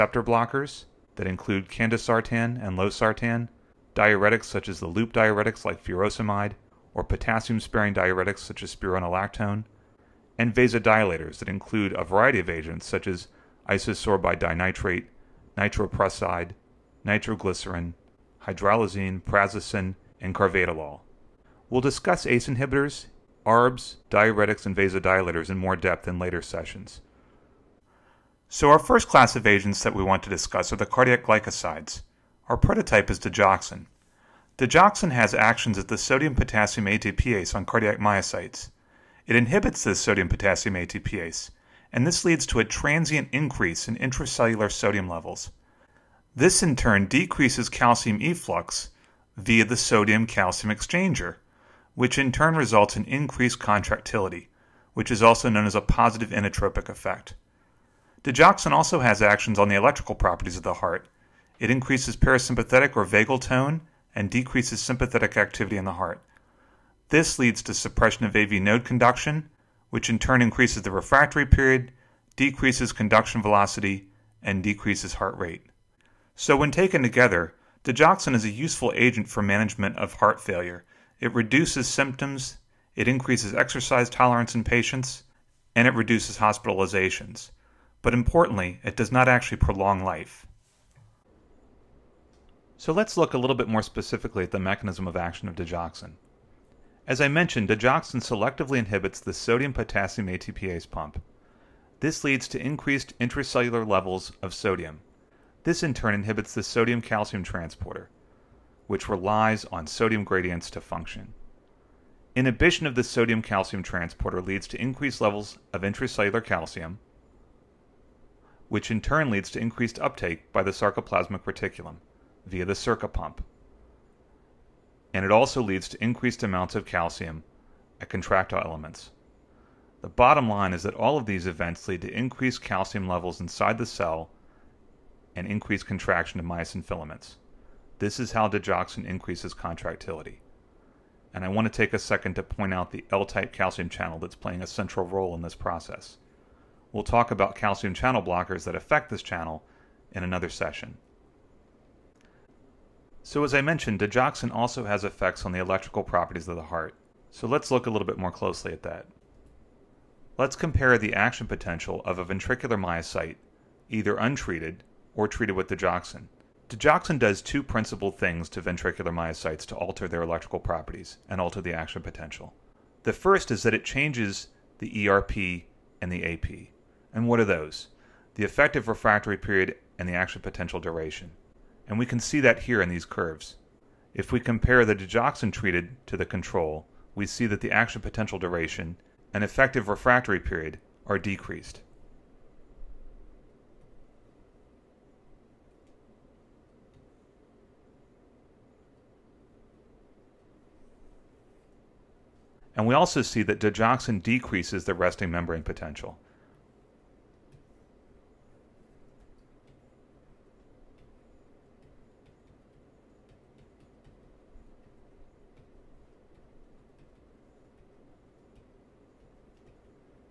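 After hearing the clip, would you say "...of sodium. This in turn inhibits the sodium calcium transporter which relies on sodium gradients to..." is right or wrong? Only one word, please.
right.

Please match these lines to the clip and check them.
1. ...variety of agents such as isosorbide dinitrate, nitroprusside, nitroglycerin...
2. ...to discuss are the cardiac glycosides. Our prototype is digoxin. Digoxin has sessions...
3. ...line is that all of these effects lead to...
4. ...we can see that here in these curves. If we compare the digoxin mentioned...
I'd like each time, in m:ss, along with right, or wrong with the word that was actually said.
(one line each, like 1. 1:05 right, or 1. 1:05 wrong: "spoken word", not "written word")
1. 0:12 right
2. 0:30 wrong: "actions", not "sessions"
3. 2:10 wrong: "events", not "effects"
4. 3:01 wrong: "treated", not "mentioned".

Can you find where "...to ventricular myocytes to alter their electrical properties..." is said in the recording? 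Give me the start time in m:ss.
2:48.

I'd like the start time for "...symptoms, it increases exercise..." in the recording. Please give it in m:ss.
1:21.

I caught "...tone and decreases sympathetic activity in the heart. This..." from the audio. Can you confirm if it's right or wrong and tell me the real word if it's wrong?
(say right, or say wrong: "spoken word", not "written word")
right.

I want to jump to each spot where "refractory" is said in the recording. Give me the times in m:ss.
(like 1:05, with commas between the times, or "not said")
1:10, 2:58, 3:09.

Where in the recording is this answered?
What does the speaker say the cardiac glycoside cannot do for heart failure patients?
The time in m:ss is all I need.
1:29.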